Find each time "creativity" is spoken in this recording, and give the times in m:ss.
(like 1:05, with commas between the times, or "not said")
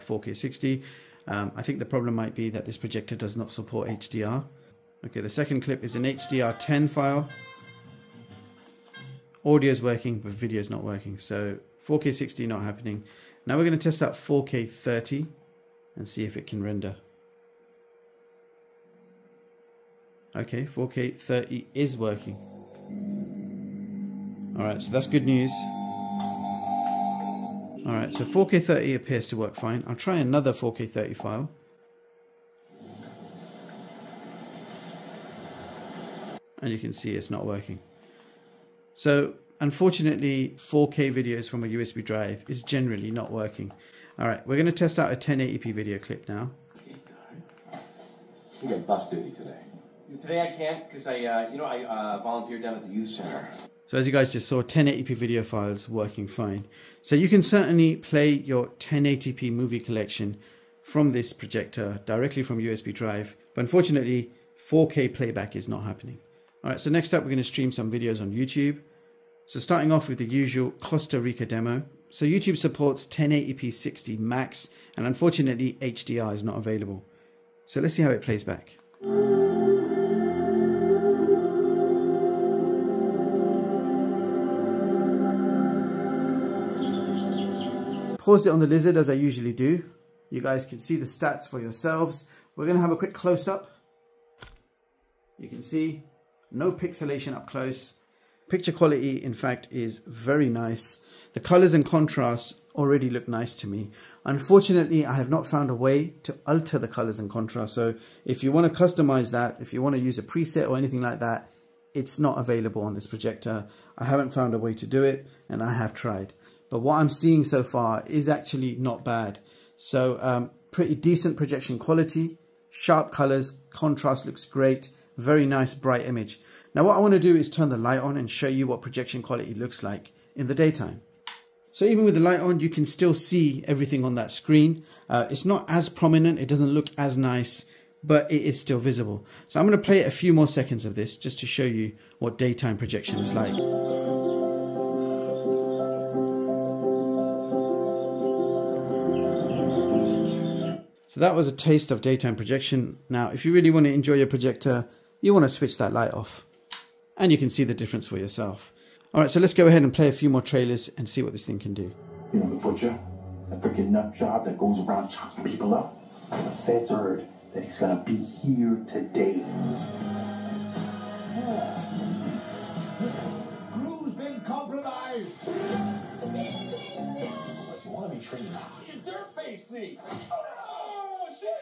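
not said.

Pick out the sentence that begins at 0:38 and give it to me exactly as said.
So unfortunately, 4K videos from a USB drive is generally not working.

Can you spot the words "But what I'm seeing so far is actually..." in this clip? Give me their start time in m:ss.
1:56.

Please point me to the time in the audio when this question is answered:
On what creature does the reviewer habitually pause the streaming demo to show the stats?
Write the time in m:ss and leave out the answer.
1:28.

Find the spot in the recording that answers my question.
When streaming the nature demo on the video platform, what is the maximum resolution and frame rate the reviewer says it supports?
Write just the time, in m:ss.
1:13.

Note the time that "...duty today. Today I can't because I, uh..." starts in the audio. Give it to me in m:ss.
0:49.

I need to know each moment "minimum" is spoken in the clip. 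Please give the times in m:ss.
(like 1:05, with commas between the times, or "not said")
not said.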